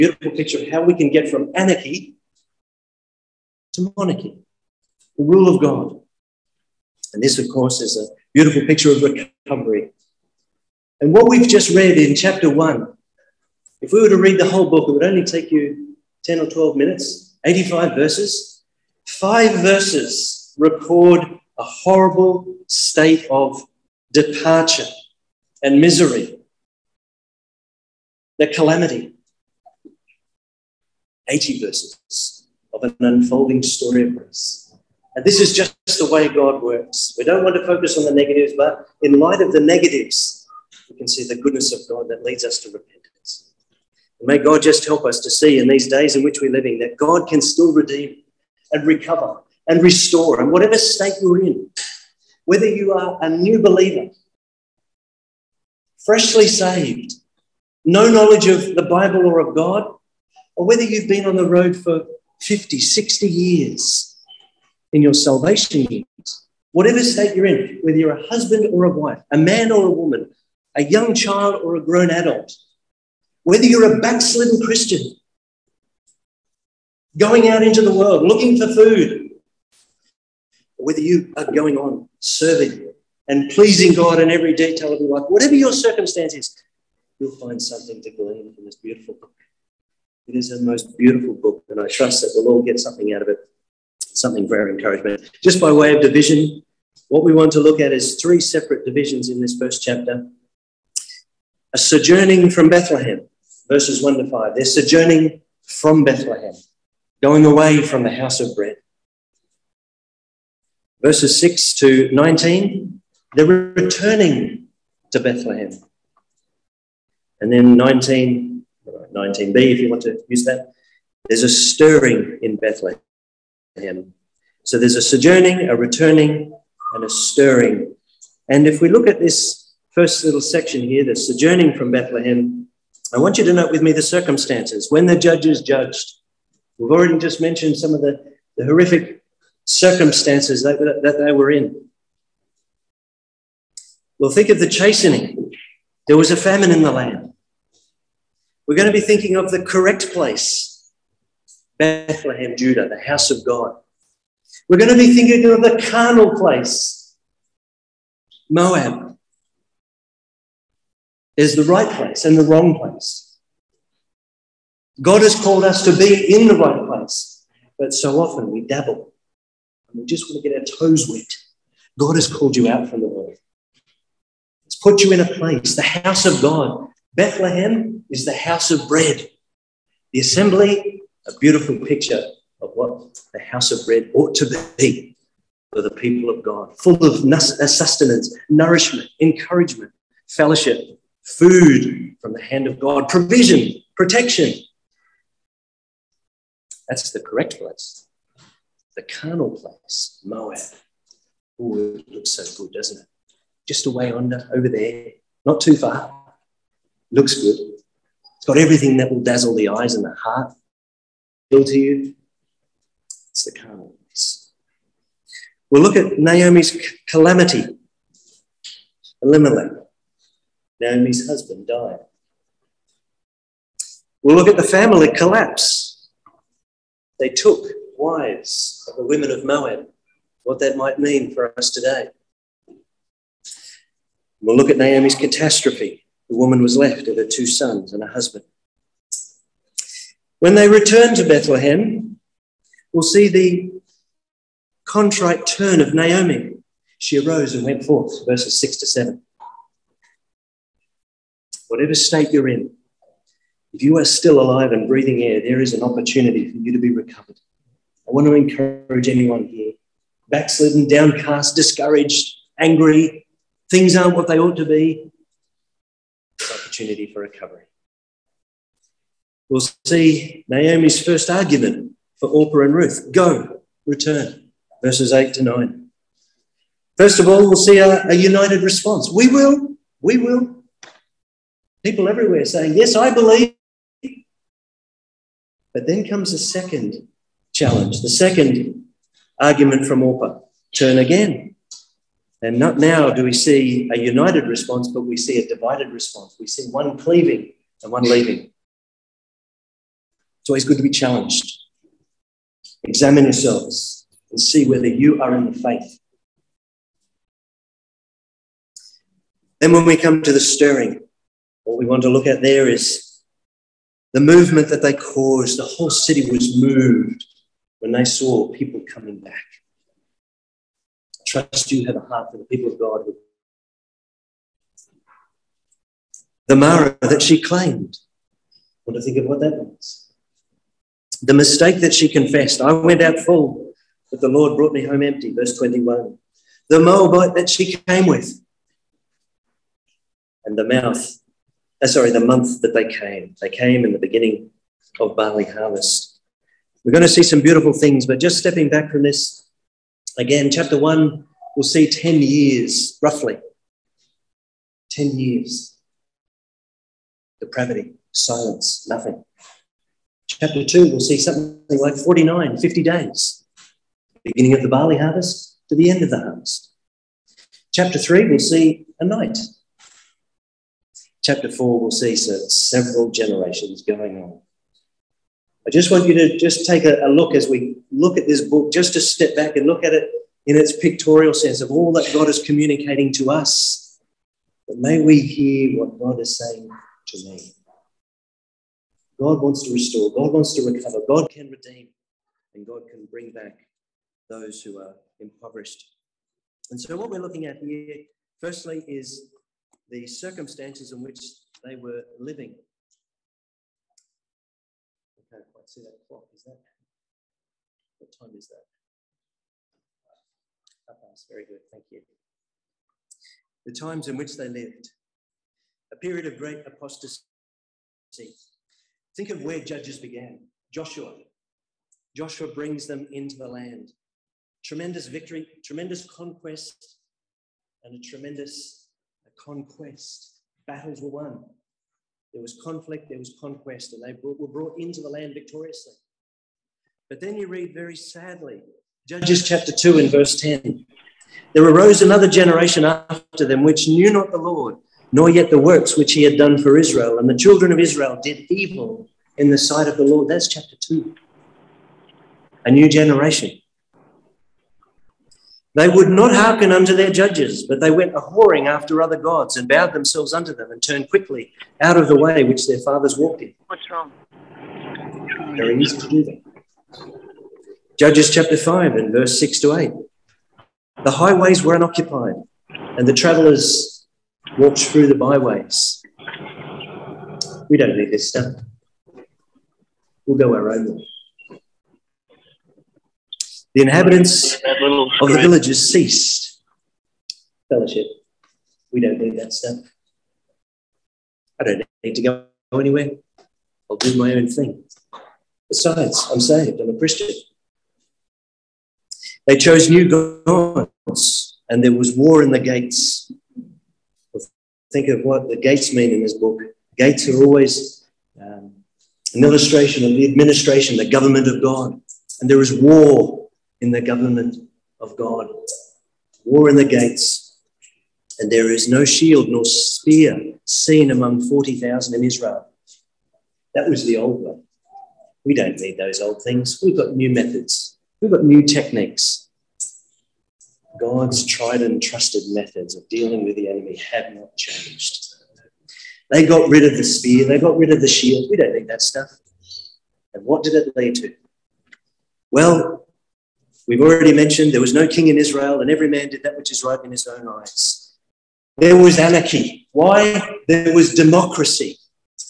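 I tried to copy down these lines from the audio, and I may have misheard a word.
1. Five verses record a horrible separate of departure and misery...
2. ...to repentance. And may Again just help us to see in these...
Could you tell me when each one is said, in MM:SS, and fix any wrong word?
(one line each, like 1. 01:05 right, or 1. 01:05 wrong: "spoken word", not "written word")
1. 00:19 wrong: "state", not "separate"
2. 00:42 wrong: "God", not "Again".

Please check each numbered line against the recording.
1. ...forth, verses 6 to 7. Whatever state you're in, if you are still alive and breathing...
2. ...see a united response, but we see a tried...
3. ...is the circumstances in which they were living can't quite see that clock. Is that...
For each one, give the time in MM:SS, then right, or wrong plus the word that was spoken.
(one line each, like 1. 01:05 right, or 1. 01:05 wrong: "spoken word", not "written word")
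1. 04:07 right
2. 04:53 wrong: "divided", not "tried"
3. 06:38 right.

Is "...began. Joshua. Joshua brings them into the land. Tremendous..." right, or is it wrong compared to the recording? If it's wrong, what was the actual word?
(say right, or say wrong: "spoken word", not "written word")
right.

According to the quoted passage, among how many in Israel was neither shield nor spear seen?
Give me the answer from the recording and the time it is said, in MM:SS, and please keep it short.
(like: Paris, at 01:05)
40,000, at 08:41.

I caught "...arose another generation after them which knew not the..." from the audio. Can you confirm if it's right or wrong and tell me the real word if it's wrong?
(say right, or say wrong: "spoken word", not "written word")
right.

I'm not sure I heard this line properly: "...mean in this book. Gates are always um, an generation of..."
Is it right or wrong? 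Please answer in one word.
wrong.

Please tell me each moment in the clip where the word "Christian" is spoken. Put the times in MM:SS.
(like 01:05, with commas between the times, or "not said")
01:14, 08:16.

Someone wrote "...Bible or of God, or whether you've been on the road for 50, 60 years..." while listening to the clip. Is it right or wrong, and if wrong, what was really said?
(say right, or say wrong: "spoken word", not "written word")
right.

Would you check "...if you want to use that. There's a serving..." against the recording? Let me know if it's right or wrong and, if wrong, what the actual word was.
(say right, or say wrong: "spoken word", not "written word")
wrong: "stirring", not "serving".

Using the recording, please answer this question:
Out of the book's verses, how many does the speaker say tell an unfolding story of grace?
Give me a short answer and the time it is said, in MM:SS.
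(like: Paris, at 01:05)
80, at 00:31.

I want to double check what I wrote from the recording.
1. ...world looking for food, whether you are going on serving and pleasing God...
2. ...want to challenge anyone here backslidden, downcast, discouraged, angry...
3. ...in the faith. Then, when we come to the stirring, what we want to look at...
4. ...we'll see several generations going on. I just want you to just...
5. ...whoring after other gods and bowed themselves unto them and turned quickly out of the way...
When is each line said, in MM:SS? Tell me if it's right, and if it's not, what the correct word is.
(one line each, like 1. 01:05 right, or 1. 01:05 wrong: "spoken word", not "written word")
1. 01:17 right
2. 04:18 wrong: "encourage", not "challenge"
3. 05:05 right
4. 06:11 right
5. 07:38 right.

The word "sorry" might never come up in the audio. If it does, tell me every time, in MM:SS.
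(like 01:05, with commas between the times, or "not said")
05:41.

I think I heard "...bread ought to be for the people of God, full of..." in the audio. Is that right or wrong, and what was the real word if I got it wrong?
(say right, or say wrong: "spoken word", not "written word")
right.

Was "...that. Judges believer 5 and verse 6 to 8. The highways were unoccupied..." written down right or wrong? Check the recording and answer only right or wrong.
wrong.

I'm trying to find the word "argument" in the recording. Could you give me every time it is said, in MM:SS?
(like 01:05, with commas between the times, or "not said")
04:31, 04:49.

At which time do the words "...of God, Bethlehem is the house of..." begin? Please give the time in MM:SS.
02:56.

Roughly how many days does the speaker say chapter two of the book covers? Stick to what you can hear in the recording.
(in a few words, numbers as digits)
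49 or 50 days.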